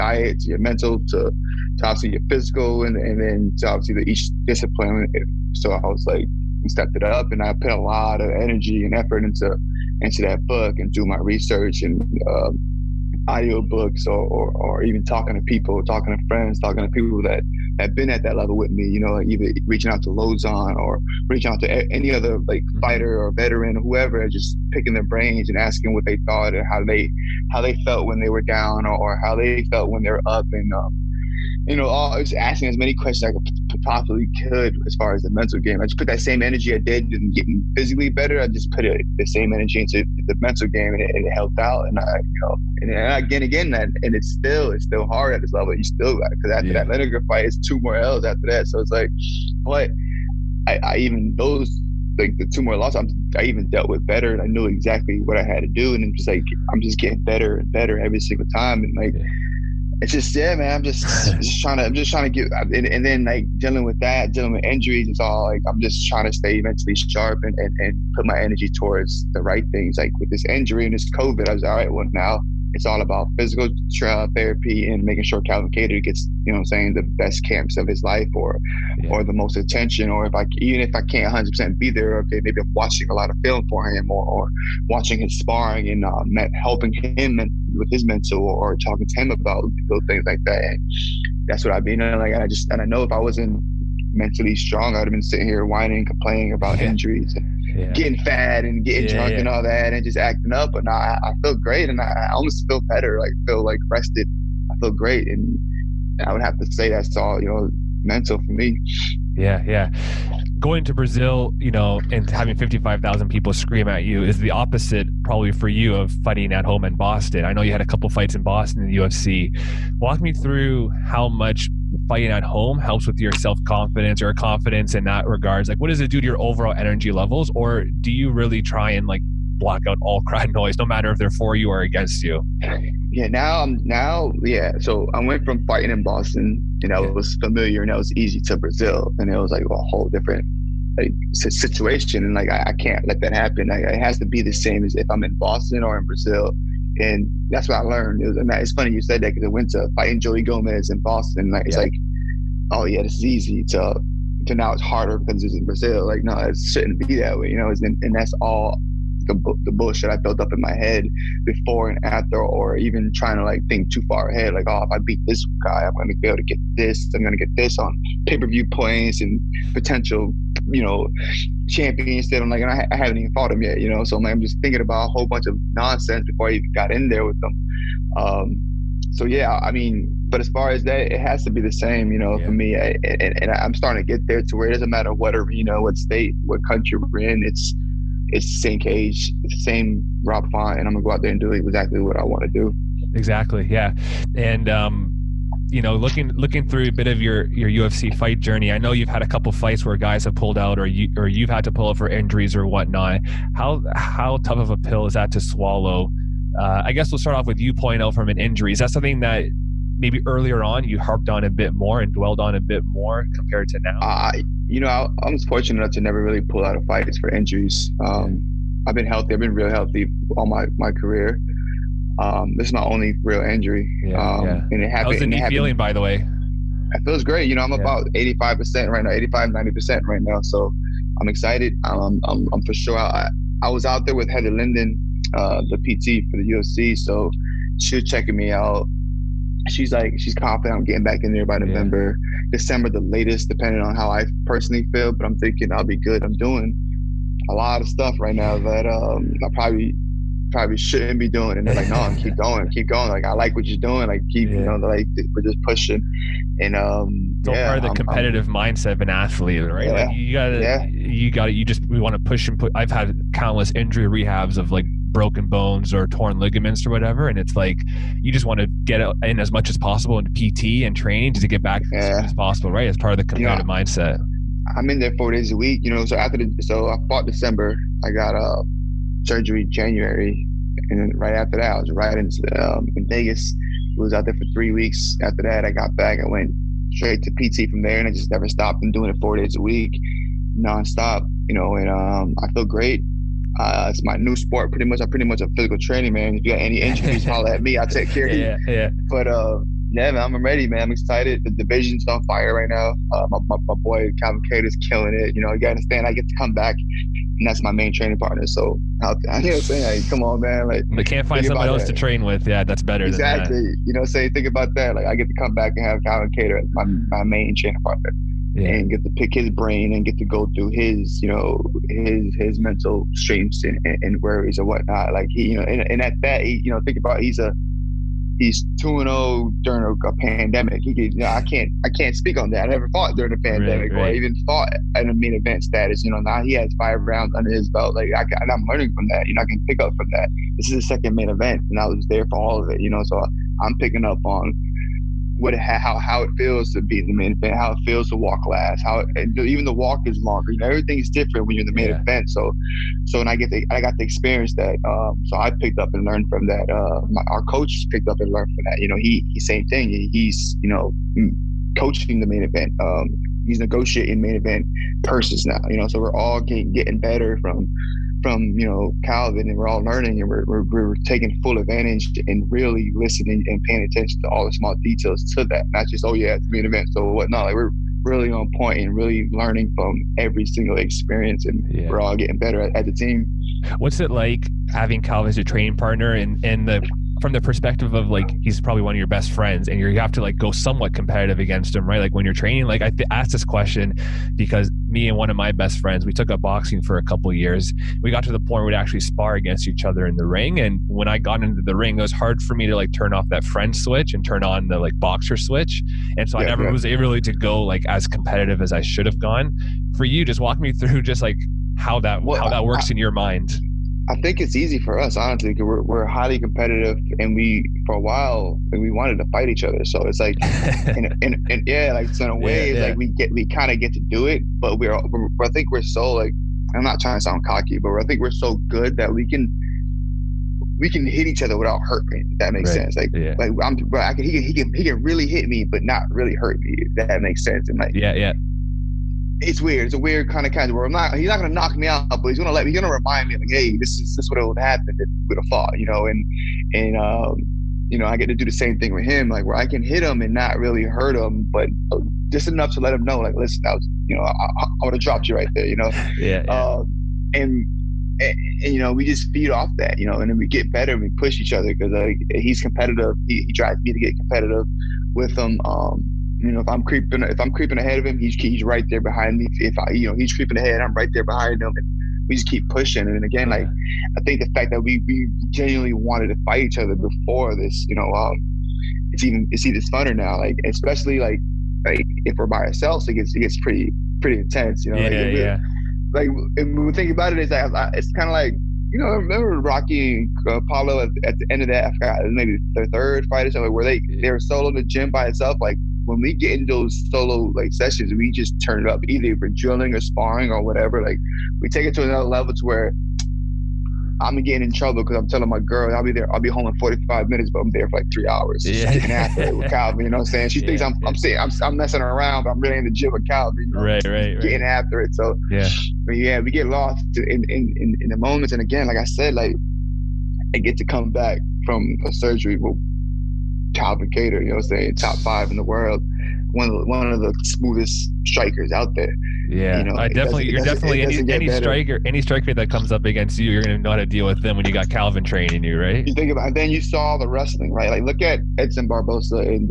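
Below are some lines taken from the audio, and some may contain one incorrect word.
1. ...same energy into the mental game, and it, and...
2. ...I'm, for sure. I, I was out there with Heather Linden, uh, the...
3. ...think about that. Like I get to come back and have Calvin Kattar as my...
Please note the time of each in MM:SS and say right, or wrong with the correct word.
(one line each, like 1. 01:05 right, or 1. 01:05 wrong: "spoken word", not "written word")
1. 00:39 right
2. 03:52 right
3. 05:14 right.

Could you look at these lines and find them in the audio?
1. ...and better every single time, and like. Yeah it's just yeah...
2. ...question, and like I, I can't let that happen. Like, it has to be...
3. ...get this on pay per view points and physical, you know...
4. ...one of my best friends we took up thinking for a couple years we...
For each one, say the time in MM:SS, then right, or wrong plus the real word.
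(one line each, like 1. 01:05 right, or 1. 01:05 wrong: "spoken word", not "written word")
1. 00:57 right
2. 02:21 wrong: "situation", not "question"
3. 02:47 wrong: "potential", not "physical"
4. 06:35 wrong: "boxing", not "thinking".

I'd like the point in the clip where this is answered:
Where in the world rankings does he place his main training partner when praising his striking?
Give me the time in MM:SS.
08:44.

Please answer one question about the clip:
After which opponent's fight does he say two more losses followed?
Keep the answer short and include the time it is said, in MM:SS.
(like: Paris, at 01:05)
Lineker, at 00:46.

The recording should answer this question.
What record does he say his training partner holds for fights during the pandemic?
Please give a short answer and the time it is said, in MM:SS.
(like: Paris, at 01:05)
2-0, at 05:28.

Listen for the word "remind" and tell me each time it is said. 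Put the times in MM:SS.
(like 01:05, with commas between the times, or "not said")
07:22.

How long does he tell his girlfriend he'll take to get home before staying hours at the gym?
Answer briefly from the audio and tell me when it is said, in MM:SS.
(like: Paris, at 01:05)
45 minutes, at 08:26.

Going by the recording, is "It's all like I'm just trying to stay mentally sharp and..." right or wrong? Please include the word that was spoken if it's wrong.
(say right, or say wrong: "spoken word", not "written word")
right.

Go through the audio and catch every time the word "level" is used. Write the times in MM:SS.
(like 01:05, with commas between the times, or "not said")
00:18, 00:45, 02:07, 08:22.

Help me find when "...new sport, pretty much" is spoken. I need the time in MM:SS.
04:54.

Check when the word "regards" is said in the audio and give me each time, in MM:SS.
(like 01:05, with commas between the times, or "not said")
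02:05.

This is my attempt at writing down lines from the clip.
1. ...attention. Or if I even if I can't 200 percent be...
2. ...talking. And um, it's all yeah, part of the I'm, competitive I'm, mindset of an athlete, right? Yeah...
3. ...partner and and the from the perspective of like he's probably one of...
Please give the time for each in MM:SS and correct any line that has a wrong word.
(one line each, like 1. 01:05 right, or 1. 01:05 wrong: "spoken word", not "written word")
1. 01:19 wrong: "100", not "200"
2. 04:15 wrong: "pushing", not "talking"
3. 06:25 right.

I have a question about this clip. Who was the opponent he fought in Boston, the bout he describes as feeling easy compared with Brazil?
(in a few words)
Joey Gomez.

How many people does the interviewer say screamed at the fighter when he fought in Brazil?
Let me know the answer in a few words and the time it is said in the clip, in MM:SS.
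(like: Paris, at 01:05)
55,000, at 01:52.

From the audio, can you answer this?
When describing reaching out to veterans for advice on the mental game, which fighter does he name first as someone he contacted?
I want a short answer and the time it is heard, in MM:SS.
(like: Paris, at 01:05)
Lauzon, at 00:20.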